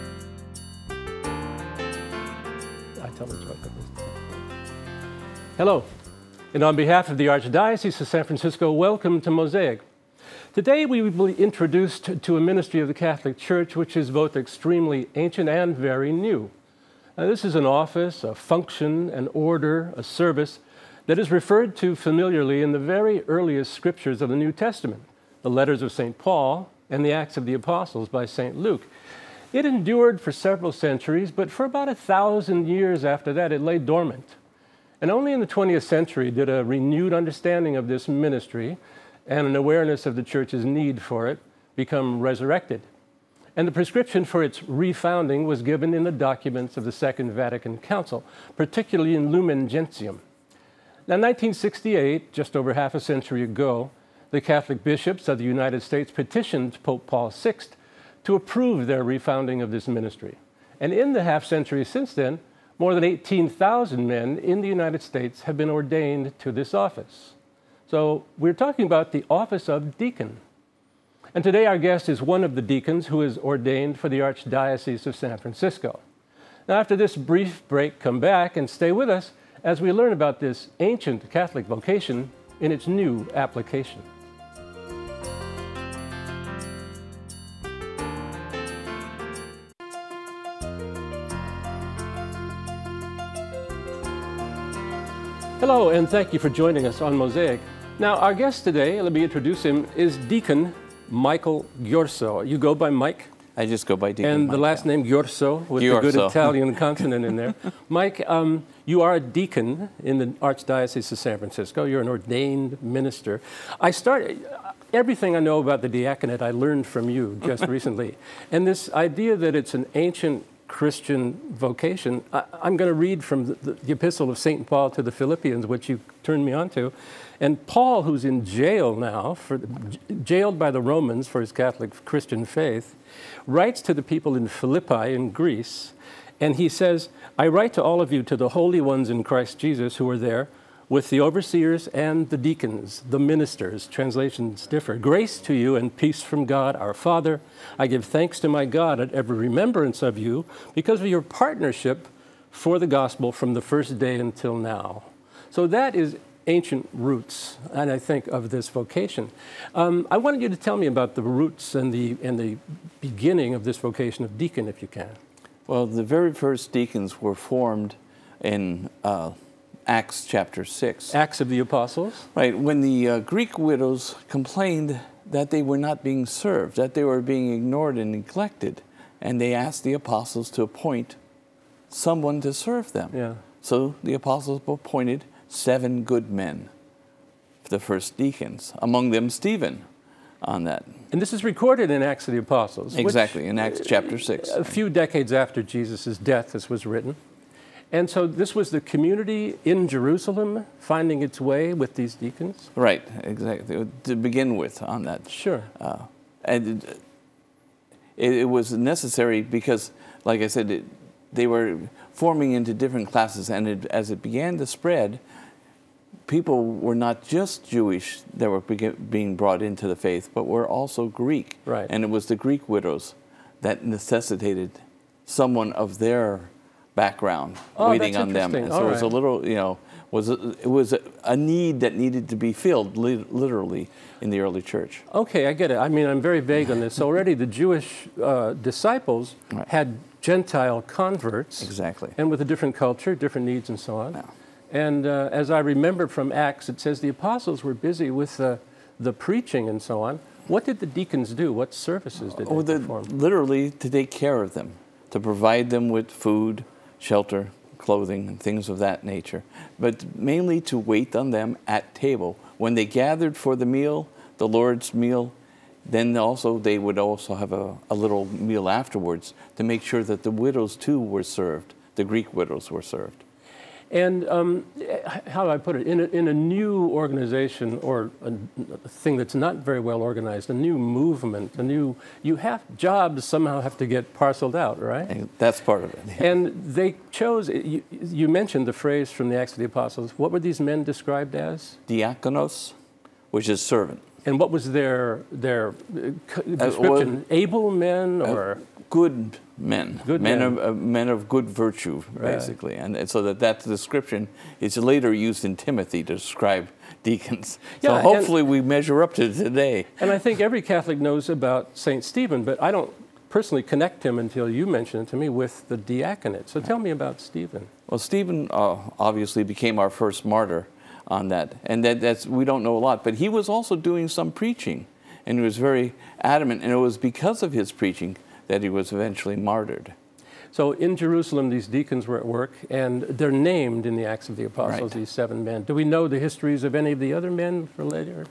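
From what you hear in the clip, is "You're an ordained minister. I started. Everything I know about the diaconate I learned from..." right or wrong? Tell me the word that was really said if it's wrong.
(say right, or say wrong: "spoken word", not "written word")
right.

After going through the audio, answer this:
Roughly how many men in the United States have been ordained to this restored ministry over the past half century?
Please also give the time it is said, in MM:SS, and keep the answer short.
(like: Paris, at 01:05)
more than 18,000, at 01:02.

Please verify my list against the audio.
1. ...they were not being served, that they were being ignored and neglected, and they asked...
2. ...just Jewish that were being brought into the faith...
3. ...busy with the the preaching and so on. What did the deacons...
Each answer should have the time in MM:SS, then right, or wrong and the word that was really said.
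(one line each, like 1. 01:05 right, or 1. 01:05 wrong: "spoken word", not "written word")
1. 02:55 right
2. 03:37 right
3. 04:07 right.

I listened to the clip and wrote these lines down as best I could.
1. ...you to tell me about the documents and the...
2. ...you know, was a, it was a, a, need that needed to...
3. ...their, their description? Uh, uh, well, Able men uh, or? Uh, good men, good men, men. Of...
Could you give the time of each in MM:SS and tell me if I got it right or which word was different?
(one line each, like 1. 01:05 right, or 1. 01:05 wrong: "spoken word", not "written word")
1. 02:40 wrong: "roots", not "documents"
2. 03:49 right
3. 04:54 right.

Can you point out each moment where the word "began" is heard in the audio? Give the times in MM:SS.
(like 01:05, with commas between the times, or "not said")
03:34.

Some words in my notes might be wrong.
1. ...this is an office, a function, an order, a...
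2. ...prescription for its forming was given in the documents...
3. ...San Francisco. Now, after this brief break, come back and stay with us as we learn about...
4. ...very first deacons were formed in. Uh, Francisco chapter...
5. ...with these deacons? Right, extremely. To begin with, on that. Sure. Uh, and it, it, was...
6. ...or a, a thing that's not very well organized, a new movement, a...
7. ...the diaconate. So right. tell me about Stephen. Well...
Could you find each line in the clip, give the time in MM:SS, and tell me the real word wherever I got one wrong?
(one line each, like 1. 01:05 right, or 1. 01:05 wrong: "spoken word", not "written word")
1. 00:17 right
2. 00:43 wrong: "refounding", not "forming"
3. 01:15 right
4. 02:46 wrong: "Acts", not "Francisco"
5. 03:21 wrong: "exactly", not "extremely"
6. 04:37 right
7. 05:15 right.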